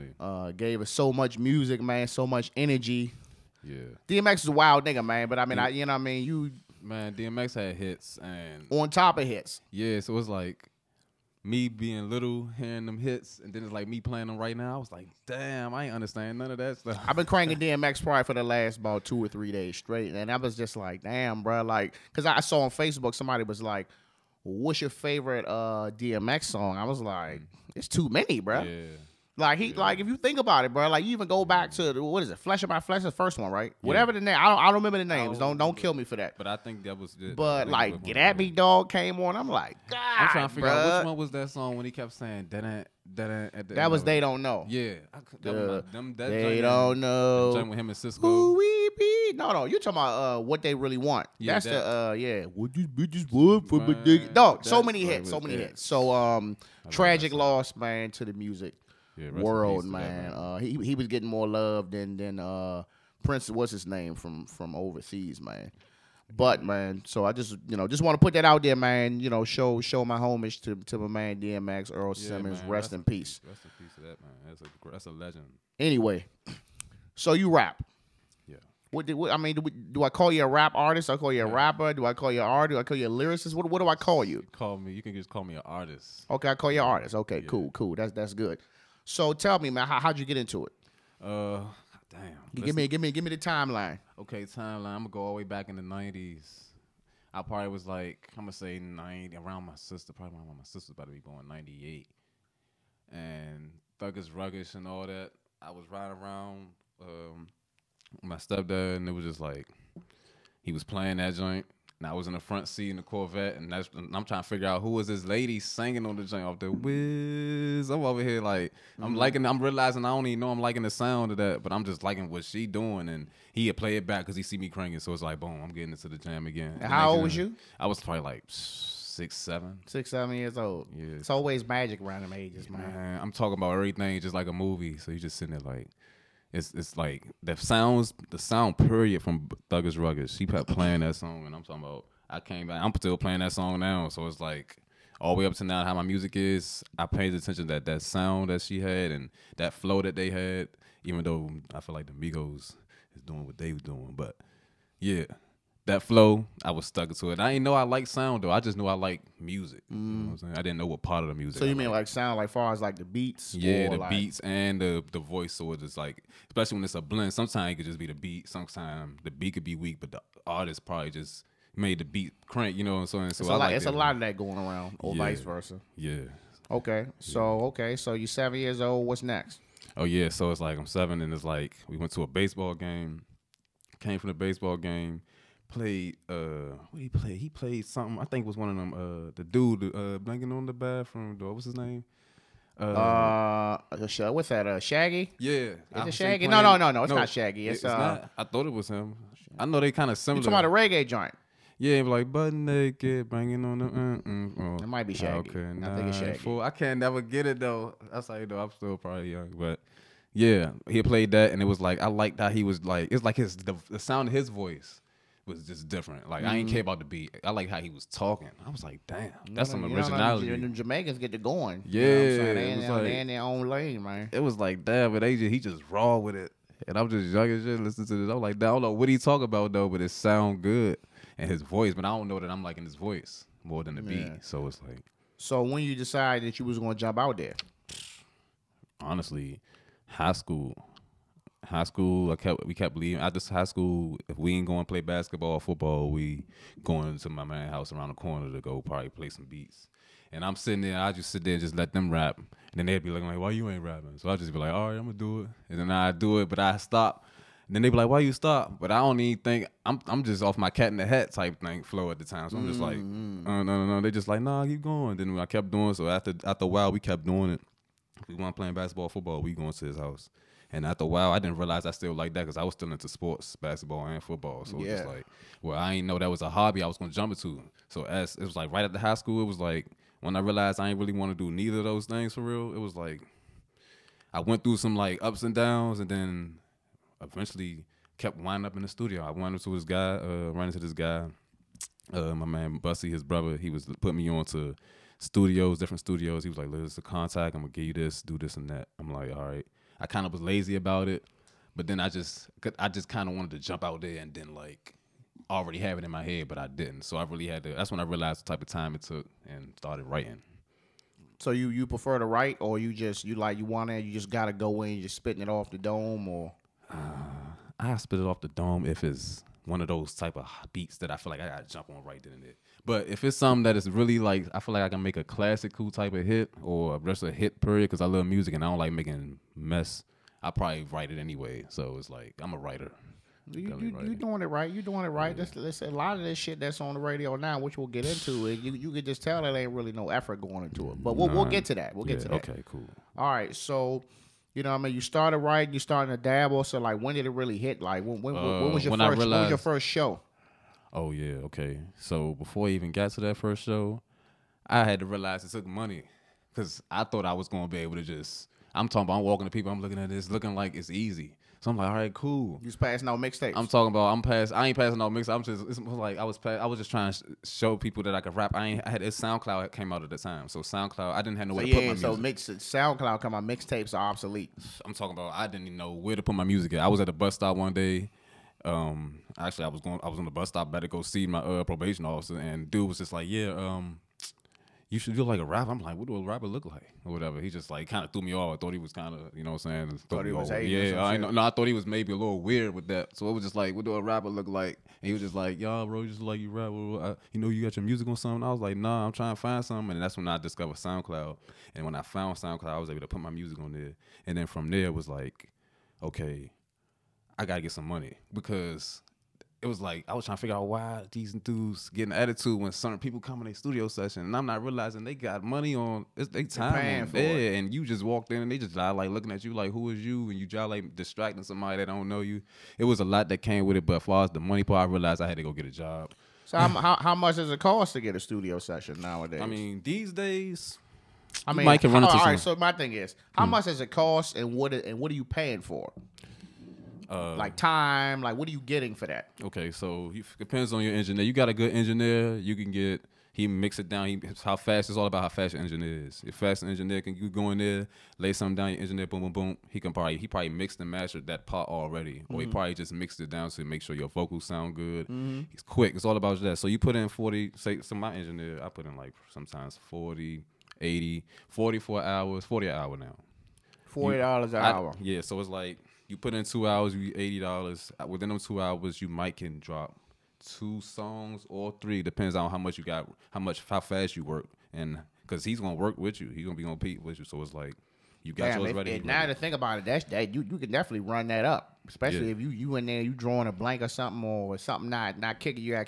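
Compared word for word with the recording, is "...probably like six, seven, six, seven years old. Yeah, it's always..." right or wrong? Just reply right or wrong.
right.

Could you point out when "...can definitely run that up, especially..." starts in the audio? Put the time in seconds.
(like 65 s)
480 s.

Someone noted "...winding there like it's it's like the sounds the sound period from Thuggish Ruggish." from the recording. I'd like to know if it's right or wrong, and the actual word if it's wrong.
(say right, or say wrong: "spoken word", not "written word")
wrong: "sitting", not "winding".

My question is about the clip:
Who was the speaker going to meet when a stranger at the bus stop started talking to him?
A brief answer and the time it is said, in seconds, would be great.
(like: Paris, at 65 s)
Probation officer, at 381 s.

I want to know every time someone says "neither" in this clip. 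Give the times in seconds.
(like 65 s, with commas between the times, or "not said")
281 s.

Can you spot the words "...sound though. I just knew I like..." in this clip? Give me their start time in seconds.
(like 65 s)
158 s.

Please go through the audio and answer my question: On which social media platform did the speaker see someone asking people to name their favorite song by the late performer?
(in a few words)
Facebook.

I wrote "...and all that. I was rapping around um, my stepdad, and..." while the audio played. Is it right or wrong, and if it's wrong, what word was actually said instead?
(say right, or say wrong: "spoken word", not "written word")
wrong: "riding", not "rapping".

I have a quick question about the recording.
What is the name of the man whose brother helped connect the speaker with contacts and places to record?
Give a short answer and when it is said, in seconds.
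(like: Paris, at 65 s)
Bussy, at 292 s.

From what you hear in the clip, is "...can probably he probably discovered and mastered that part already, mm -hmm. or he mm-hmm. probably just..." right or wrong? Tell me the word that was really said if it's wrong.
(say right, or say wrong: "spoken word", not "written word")
wrong: "mixed", not "discovered".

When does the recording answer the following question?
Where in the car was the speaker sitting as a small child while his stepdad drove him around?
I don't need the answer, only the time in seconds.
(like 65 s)
112 s.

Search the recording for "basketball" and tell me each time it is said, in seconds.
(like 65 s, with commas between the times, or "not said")
245 s, 268 s, 273 s.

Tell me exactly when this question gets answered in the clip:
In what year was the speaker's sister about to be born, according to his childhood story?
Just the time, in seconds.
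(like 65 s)
101 s.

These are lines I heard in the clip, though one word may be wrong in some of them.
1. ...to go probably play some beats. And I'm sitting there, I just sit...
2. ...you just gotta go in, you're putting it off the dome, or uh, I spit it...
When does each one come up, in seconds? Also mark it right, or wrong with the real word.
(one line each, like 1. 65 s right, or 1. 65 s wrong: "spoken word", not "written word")
1. 248 s right
2. 314 s wrong: "spitting", not "putting".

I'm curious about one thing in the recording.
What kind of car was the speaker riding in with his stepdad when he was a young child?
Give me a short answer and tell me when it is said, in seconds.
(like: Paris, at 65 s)
Corvette, at 113 s.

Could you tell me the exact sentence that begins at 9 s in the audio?
Yeah, so was like me being little, hearing them hits, and then it's like me playing them right now.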